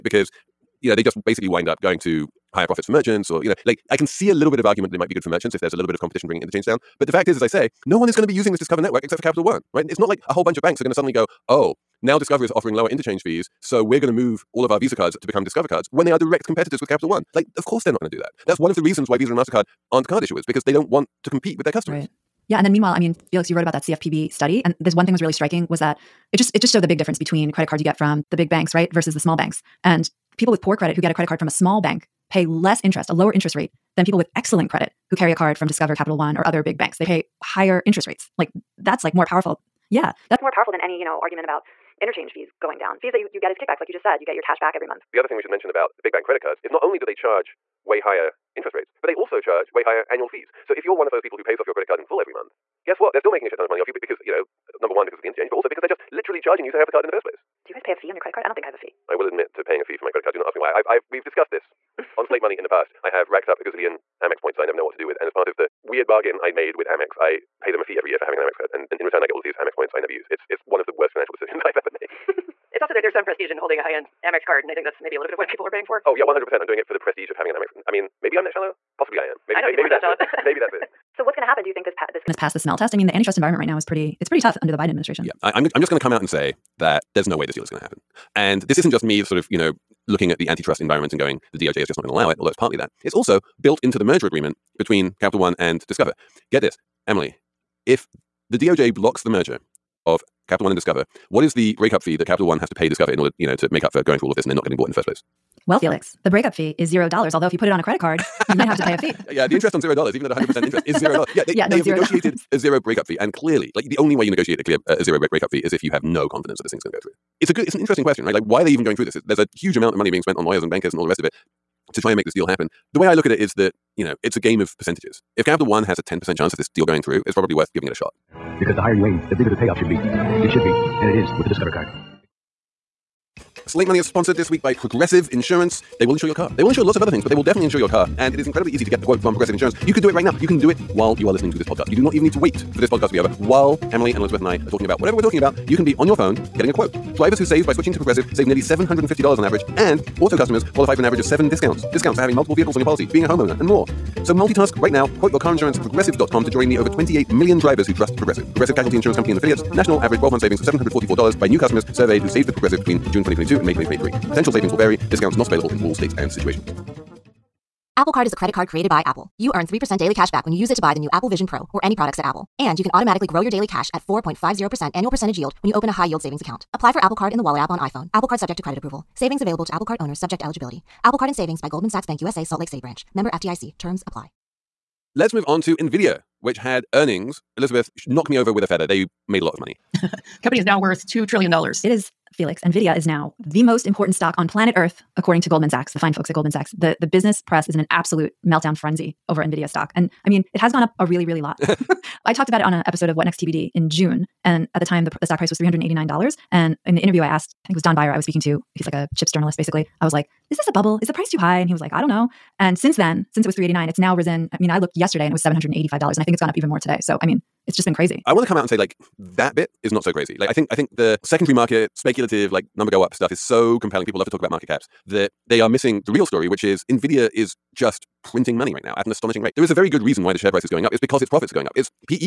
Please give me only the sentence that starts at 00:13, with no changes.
So we're going to move all of our Visa cards to become Discover cards when they are direct competitors with Capital One.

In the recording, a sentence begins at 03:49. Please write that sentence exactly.
There is a very good reason why the share price is going up.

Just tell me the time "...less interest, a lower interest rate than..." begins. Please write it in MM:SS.
00:32.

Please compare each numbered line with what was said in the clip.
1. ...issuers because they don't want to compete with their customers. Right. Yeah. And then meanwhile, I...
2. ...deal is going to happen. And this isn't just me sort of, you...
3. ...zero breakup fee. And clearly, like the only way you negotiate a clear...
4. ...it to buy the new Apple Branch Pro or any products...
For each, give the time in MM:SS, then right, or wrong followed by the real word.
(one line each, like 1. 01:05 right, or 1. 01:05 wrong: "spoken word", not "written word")
1. 00:20 right
2. 01:27 right
3. 01:52 right
4. 02:50 wrong: "Vision", not "Branch".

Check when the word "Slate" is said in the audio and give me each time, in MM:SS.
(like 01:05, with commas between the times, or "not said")
01:02, 02:13.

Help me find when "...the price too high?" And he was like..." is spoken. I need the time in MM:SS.
03:31.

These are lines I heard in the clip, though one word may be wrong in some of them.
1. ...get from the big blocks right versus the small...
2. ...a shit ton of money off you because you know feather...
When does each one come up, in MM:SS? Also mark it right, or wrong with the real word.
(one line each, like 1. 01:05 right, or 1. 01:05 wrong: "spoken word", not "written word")
1. 00:27 wrong: "banks", not "blocks"
2. 00:53 wrong: "number", not "feather".